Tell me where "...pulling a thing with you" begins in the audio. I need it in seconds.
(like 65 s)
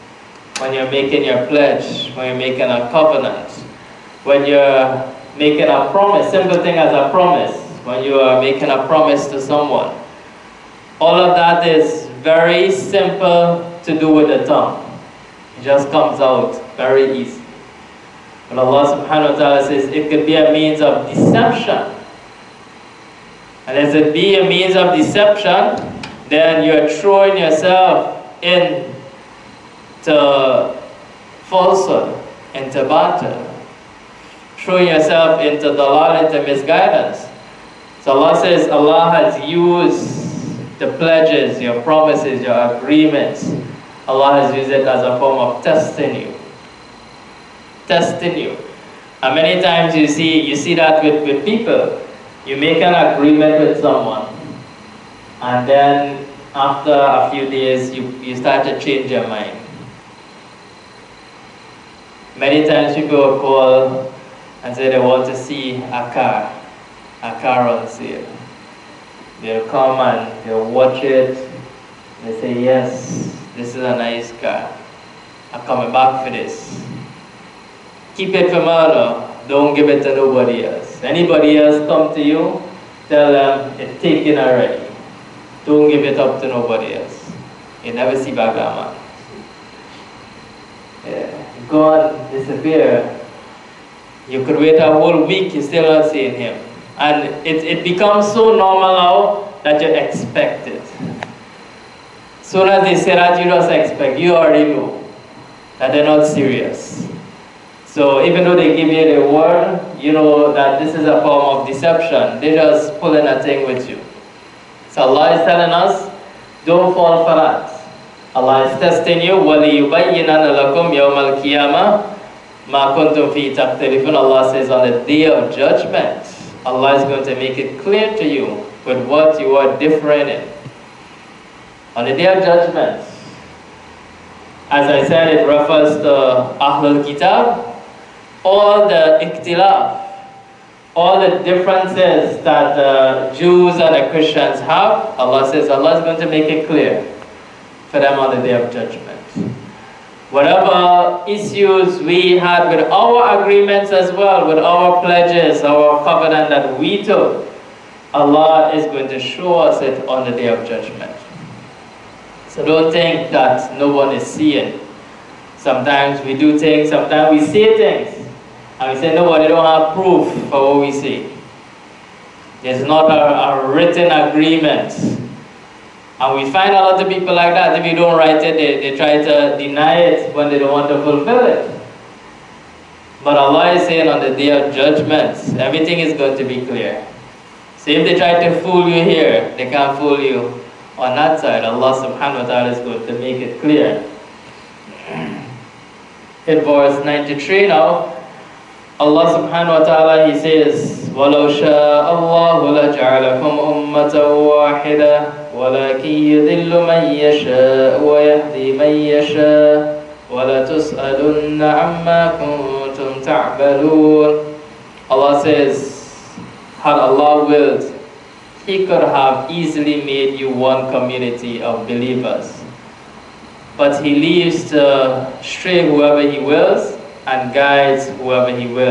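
112 s.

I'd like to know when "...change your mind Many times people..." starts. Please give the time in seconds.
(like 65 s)
58 s.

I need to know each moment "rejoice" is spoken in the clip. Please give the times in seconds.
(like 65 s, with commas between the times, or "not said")
not said.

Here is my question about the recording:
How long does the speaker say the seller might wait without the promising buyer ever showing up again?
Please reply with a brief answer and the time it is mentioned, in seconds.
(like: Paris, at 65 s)
A whole week, at 94 s.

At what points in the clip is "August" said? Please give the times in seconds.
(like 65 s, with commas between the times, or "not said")
not said.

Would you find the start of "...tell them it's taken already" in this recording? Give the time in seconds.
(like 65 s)
83 s.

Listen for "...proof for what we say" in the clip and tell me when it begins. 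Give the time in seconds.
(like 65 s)
169 s.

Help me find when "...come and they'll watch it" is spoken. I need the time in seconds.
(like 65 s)
69 s.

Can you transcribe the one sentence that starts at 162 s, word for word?
So don't think that no one is seeing.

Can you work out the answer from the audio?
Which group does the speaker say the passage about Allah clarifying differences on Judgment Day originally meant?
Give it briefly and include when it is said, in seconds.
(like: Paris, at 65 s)
Ahlul Kitab, at 136 s.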